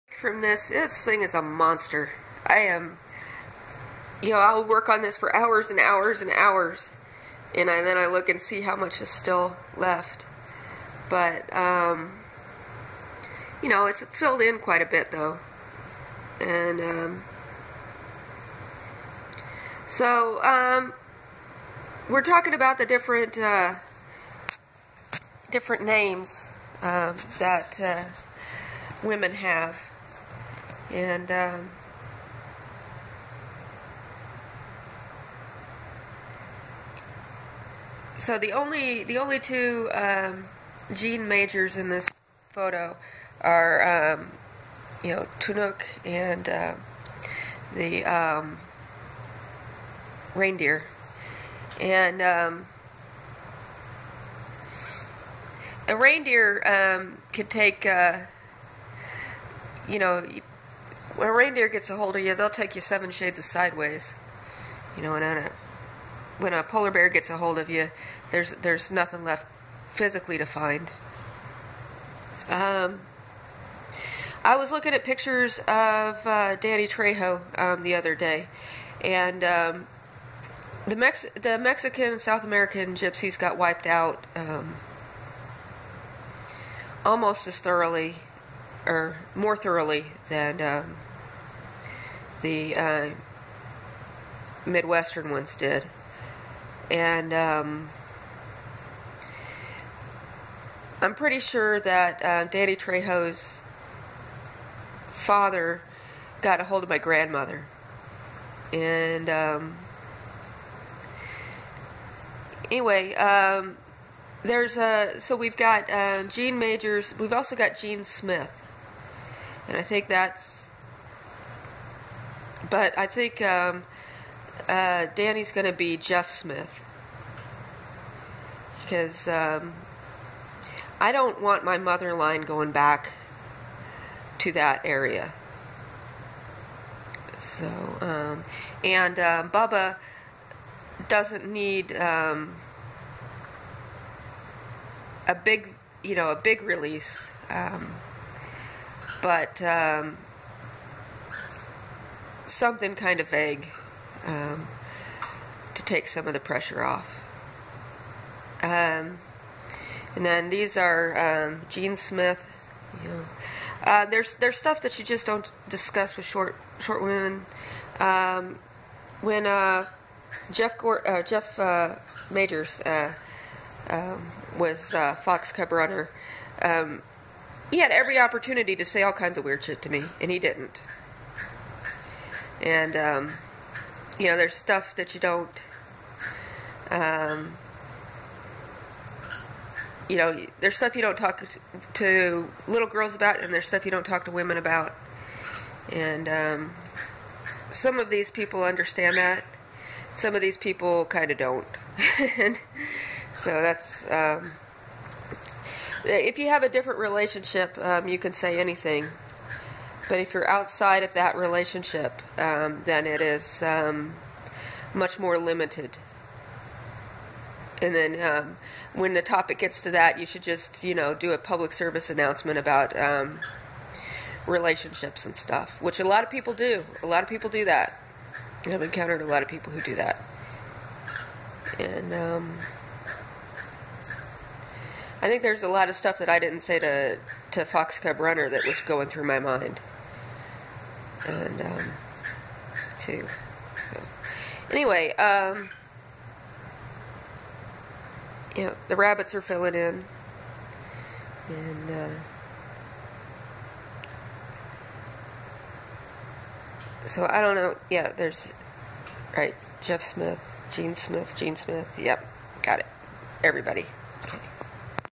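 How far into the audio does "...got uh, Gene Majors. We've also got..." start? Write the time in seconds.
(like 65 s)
115 s.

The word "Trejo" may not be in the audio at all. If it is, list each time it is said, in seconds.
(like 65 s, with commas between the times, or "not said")
76 s, 102 s.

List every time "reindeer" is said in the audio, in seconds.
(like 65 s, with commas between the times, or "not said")
50 s, 55 s, 61 s.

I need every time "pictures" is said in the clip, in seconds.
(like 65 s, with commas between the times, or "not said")
75 s.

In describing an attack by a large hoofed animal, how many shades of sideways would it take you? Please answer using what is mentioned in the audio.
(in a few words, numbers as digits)
7.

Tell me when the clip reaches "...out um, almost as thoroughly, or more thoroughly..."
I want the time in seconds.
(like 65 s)
83 s.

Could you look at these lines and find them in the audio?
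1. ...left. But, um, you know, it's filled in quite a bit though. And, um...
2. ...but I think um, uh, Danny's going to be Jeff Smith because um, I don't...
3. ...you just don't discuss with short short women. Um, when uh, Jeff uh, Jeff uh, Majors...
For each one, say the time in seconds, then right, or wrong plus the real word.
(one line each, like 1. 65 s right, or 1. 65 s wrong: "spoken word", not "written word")
1. 9 s right
2. 122 s right
3. 164 s right.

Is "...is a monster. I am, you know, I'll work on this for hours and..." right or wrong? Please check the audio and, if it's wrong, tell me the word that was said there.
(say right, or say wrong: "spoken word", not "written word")
right.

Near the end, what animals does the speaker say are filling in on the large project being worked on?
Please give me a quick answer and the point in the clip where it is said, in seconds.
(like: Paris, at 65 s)
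rabbits, at 248 s.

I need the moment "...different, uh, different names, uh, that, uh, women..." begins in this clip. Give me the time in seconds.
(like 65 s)
22 s.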